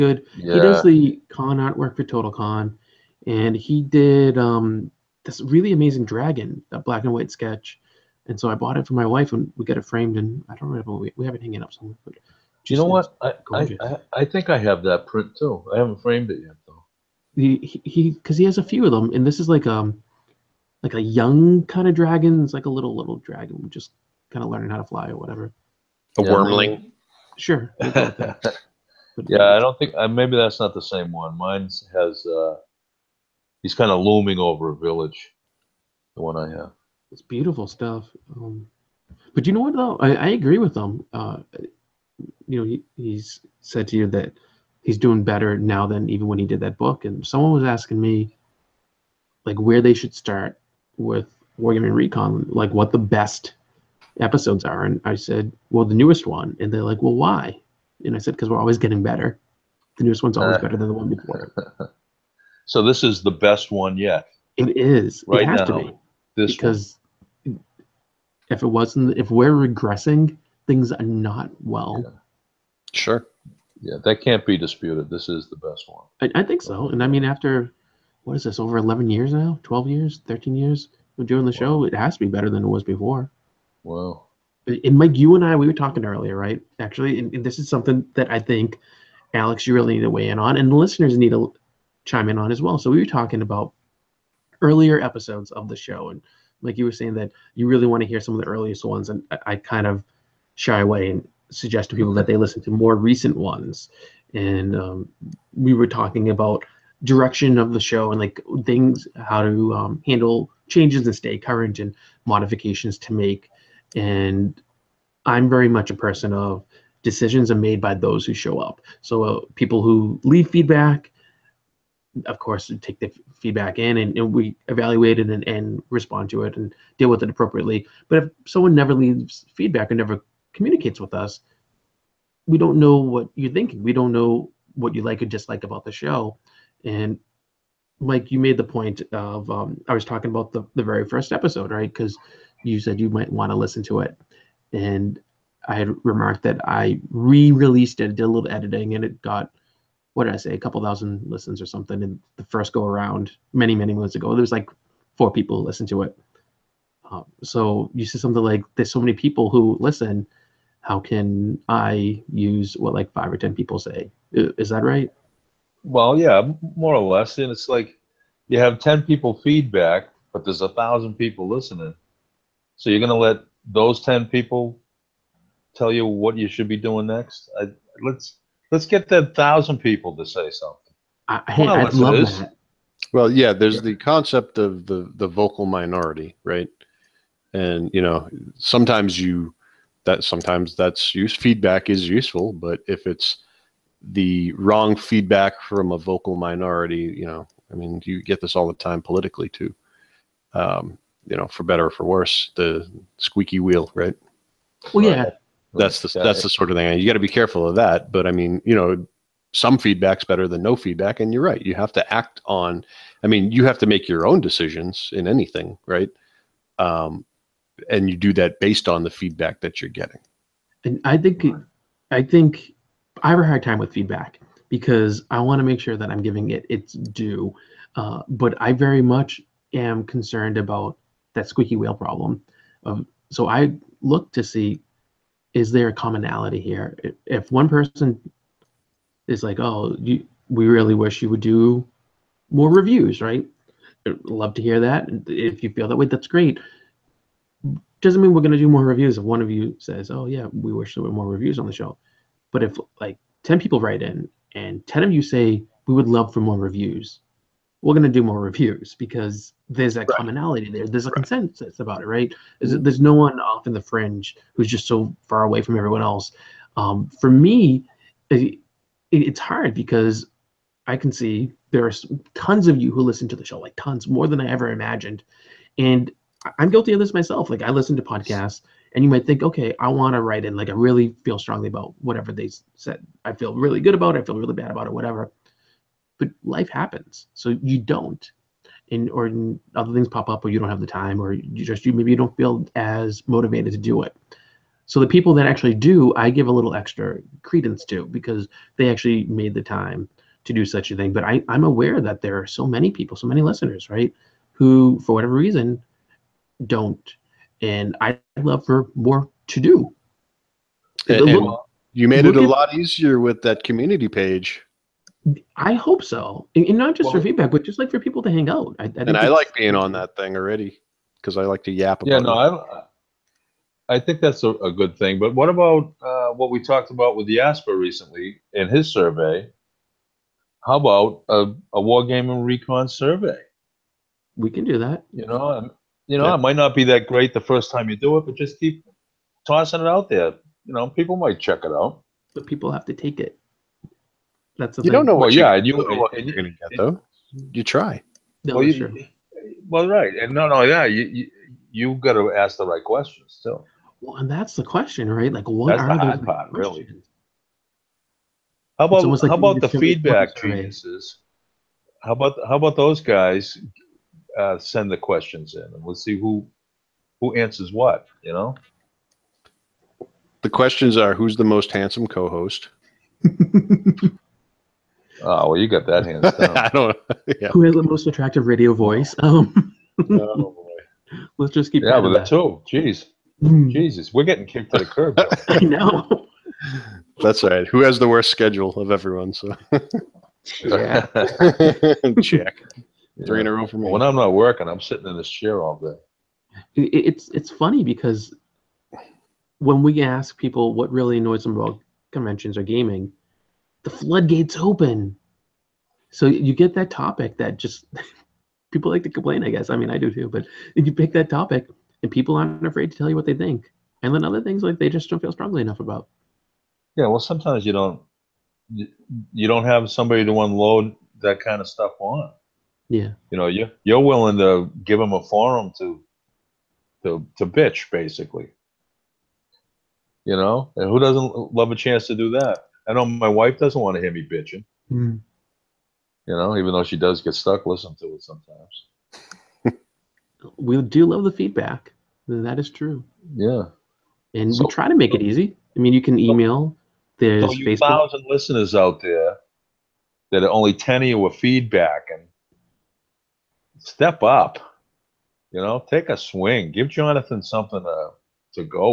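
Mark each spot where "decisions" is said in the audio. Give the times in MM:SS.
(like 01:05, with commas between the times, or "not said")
01:57, 03:34.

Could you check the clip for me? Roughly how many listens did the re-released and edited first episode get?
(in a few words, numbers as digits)
a couple thousand.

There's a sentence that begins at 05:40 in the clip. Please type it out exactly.
You know, people might check it out.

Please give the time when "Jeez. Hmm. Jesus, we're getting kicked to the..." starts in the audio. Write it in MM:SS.
06:22.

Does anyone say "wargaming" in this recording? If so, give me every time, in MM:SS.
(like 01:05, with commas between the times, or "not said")
00:51, 05:31.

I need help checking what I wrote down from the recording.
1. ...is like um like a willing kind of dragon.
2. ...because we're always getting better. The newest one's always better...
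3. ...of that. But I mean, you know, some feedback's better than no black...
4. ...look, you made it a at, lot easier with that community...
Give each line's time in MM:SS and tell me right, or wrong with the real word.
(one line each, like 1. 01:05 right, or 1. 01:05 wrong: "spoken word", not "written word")
1. 00:19 wrong: "young", not "willing"
2. 00:58 right
3. 03:27 wrong: "feedback", not "black"
4. 05:11 right.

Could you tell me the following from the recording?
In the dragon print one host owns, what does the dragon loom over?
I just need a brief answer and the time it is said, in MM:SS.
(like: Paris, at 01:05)
a village, at 00:34.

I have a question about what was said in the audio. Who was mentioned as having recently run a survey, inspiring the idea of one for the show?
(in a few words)
Jasper.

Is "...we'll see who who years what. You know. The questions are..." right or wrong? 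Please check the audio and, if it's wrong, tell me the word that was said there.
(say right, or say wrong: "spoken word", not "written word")
wrong: "answers", not "years".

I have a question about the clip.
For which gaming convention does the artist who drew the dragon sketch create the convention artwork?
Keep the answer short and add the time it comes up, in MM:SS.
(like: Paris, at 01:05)
Total Con, at 00:02.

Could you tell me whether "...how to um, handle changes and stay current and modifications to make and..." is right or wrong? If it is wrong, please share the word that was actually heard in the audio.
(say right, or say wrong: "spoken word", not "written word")
right.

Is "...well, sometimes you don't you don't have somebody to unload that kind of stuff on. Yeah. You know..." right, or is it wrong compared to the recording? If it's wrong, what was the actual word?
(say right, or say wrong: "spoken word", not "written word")
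right.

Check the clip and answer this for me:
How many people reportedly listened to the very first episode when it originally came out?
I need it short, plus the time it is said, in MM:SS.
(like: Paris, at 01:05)
4, at 02:35.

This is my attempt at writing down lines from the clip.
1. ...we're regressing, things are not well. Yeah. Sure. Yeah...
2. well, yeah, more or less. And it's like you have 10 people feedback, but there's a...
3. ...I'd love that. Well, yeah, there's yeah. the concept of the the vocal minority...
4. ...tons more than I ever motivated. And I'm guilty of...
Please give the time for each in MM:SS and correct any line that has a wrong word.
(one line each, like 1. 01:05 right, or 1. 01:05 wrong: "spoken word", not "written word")
1. 01:09 right
2. 02:45 right
3. 03:01 right
4. 04:33 wrong: "imagined", not "motivated".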